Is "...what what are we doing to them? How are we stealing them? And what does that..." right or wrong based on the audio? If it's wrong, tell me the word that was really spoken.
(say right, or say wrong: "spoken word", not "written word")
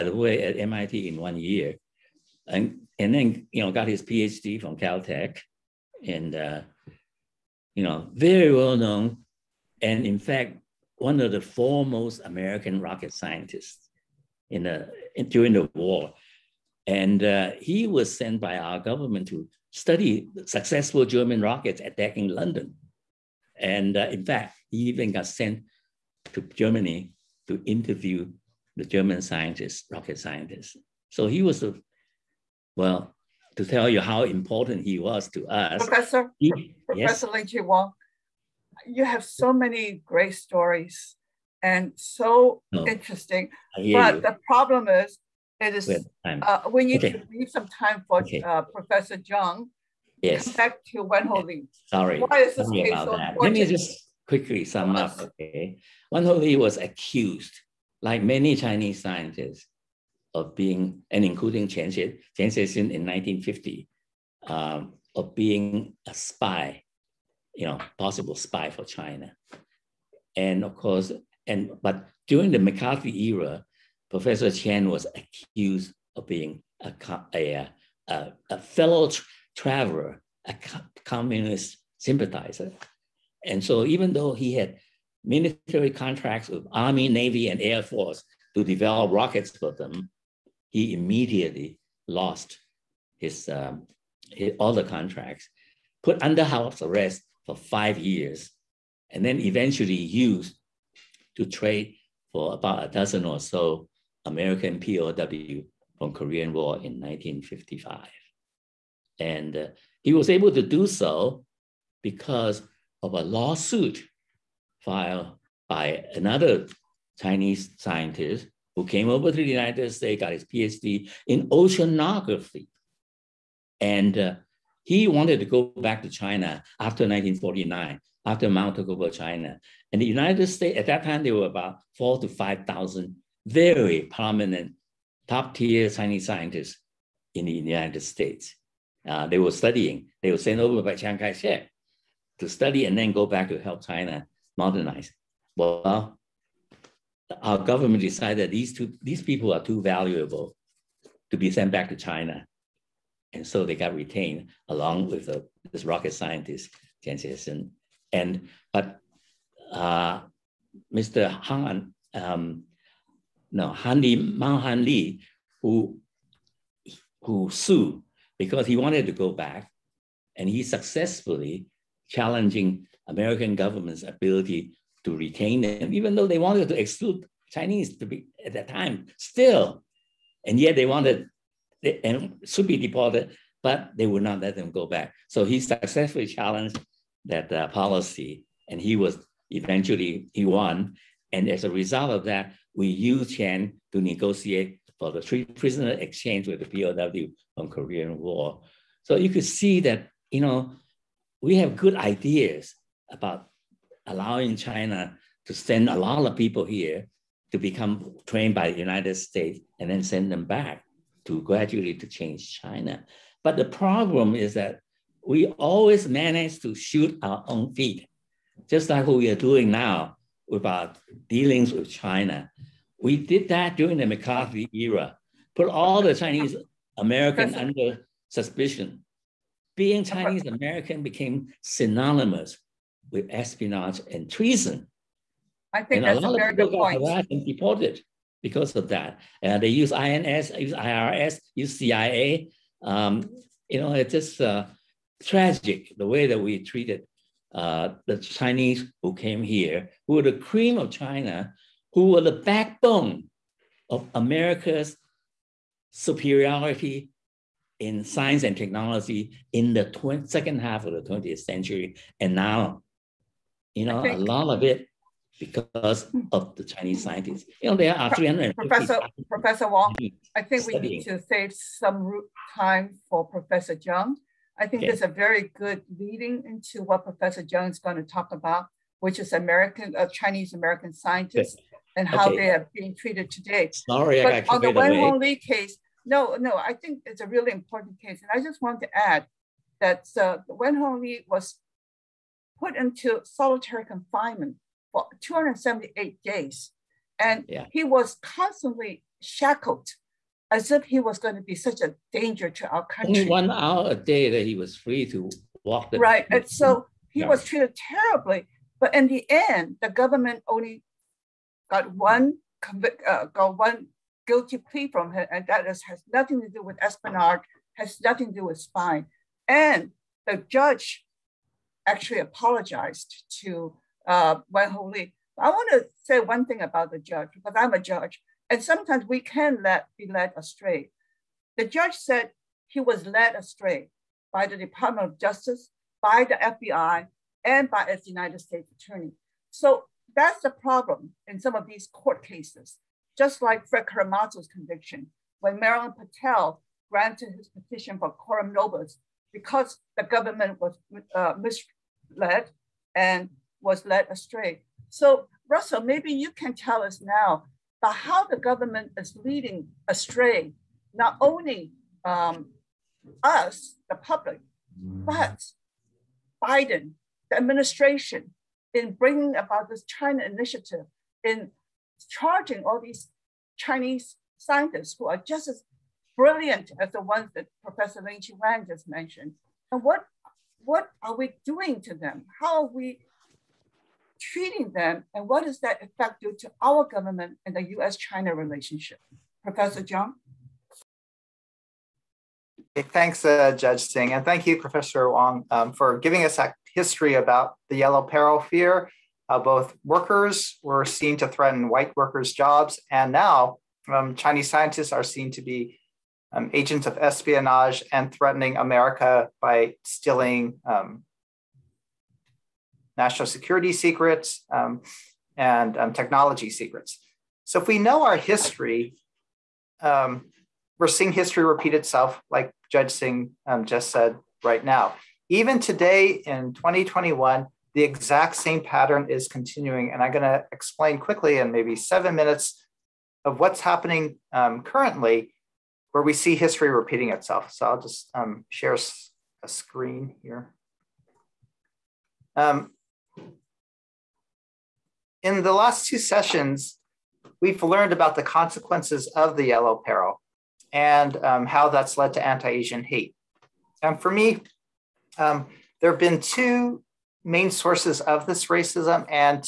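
wrong: "treating", not "stealing".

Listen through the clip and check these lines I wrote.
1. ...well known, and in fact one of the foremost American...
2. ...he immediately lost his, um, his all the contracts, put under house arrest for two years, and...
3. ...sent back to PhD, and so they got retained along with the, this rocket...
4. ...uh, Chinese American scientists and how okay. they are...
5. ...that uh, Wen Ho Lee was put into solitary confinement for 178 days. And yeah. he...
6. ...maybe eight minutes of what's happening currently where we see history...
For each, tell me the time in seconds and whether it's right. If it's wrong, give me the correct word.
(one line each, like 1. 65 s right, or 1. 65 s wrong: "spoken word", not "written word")
1. 8 s right
2. 90 s wrong: "five", not "two"
3. 151 s wrong: "China", not "PhD"
4. 279 s right
5. 289 s wrong: "278", not "178"
6. 431 s wrong: "seven", not "eight".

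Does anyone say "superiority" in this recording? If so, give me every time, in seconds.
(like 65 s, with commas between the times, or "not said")
255 s.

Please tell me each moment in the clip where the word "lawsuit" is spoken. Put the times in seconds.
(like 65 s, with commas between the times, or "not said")
113 s.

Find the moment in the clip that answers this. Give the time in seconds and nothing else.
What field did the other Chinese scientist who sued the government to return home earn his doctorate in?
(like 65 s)
121 s.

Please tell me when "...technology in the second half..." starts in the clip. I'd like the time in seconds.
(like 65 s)
258 s.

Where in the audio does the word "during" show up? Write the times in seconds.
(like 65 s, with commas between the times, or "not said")
15 s, 72 s, 223 s.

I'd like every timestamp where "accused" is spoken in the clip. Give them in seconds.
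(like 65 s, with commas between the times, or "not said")
56 s, 75 s.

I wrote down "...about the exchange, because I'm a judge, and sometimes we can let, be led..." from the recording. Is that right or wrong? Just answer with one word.
wrong.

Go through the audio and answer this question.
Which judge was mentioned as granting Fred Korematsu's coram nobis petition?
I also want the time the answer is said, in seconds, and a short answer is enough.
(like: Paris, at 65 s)
Marilyn Patel, at 345 s.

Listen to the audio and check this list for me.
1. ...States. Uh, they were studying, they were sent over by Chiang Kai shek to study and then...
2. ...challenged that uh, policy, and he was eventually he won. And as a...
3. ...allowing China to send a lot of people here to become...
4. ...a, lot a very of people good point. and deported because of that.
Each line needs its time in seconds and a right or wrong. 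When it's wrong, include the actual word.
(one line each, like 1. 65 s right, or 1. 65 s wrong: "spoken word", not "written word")
1. 137 s right
2. 186 s right
3. 204 s right
4. 236 s right.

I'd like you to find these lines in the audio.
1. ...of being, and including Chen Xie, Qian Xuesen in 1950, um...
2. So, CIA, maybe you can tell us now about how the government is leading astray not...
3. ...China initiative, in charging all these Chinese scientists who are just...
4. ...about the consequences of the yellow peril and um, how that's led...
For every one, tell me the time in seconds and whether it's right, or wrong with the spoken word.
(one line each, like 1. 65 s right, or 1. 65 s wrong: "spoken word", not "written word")
1. 60 s right
2. 354 s wrong: "Russell", not "CIA"
3. 369 s right
4. 447 s right.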